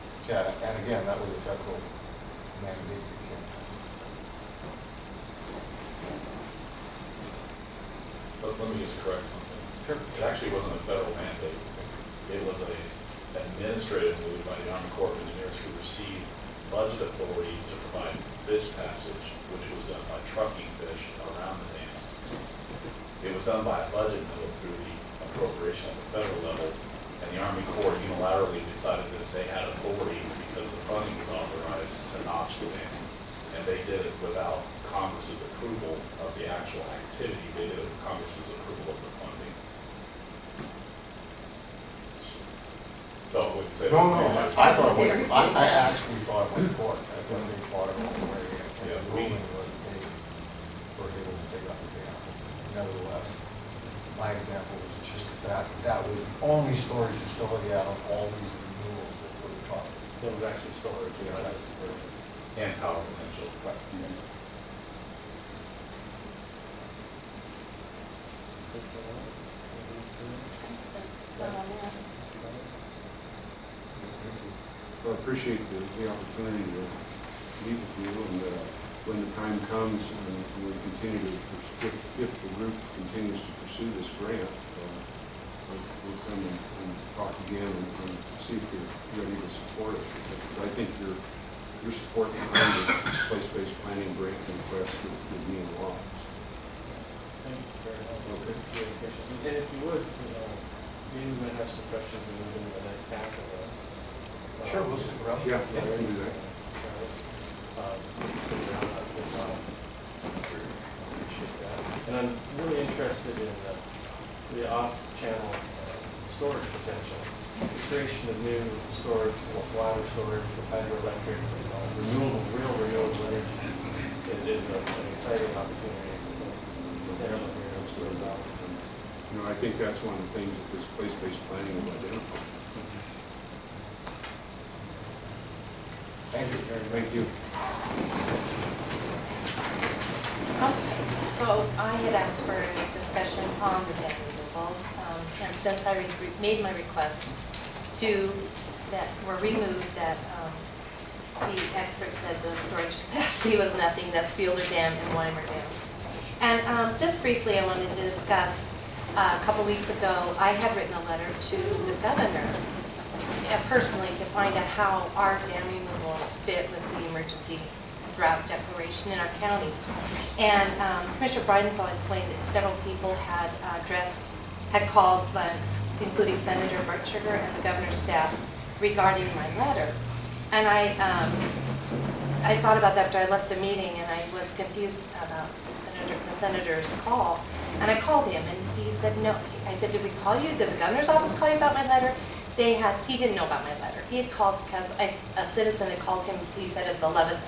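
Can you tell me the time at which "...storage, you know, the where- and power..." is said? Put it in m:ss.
1:00.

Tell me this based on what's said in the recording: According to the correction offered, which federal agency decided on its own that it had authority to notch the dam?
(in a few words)
Army Corps of Engineers.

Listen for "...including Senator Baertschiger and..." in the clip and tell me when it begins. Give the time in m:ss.
2:56.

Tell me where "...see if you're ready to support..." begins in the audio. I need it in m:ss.
1:28.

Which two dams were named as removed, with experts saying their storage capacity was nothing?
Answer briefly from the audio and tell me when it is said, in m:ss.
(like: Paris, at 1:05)
Fielder Dam and Wimer Dam, at 2:34.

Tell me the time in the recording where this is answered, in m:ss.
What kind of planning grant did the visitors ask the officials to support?
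1:33.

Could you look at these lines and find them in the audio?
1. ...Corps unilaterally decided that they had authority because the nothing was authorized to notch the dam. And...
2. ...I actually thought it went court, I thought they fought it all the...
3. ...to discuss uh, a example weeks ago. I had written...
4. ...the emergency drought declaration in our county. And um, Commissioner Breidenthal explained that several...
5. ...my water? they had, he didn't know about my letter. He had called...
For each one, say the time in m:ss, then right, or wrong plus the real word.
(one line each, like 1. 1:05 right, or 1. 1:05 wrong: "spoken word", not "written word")
1. 0:27 wrong: "funding", not "nothing"
2. 0:45 right
3. 2:37 wrong: "couple", not "example"
4. 2:46 right
5. 3:11 wrong: "letter", not "water".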